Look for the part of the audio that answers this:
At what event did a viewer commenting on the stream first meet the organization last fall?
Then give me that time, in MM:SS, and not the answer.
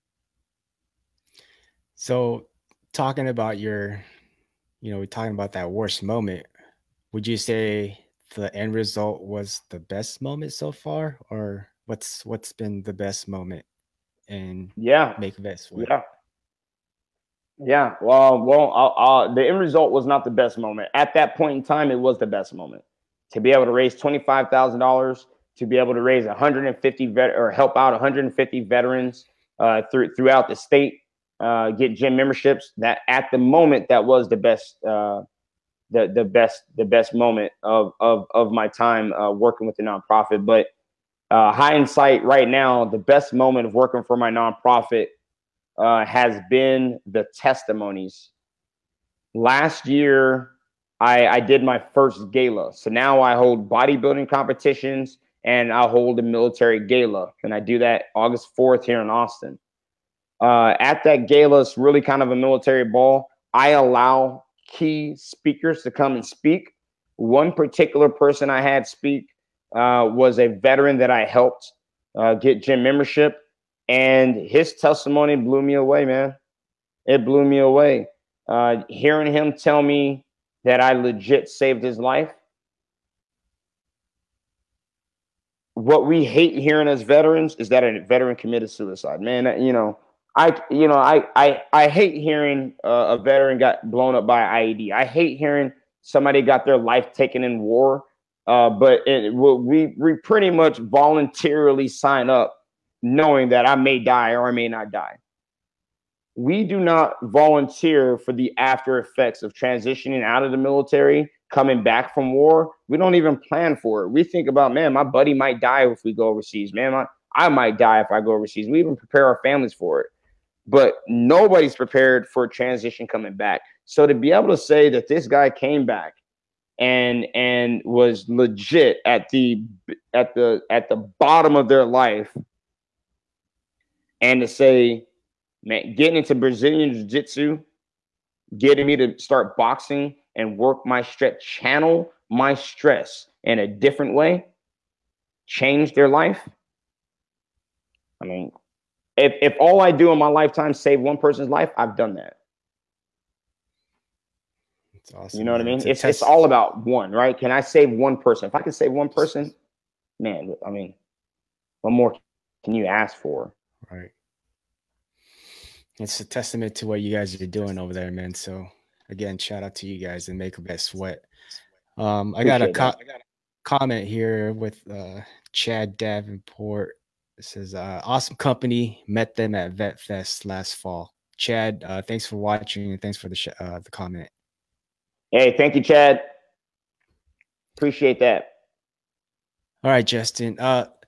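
02:59.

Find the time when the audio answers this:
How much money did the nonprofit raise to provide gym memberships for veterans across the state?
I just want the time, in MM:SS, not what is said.
00:23.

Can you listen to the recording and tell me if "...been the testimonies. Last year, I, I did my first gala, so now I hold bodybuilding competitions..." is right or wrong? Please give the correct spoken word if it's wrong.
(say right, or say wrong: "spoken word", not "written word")
right.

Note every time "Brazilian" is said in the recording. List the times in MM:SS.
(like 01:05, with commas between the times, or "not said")
02:16.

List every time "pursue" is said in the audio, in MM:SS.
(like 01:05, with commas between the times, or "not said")
not said.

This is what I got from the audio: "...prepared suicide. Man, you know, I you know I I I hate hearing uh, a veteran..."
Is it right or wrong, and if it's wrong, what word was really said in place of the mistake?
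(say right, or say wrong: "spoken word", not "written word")
wrong: "committed", not "prepared".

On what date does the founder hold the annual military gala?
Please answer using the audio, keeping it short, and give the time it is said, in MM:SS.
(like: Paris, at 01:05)
August 4, at 00:58.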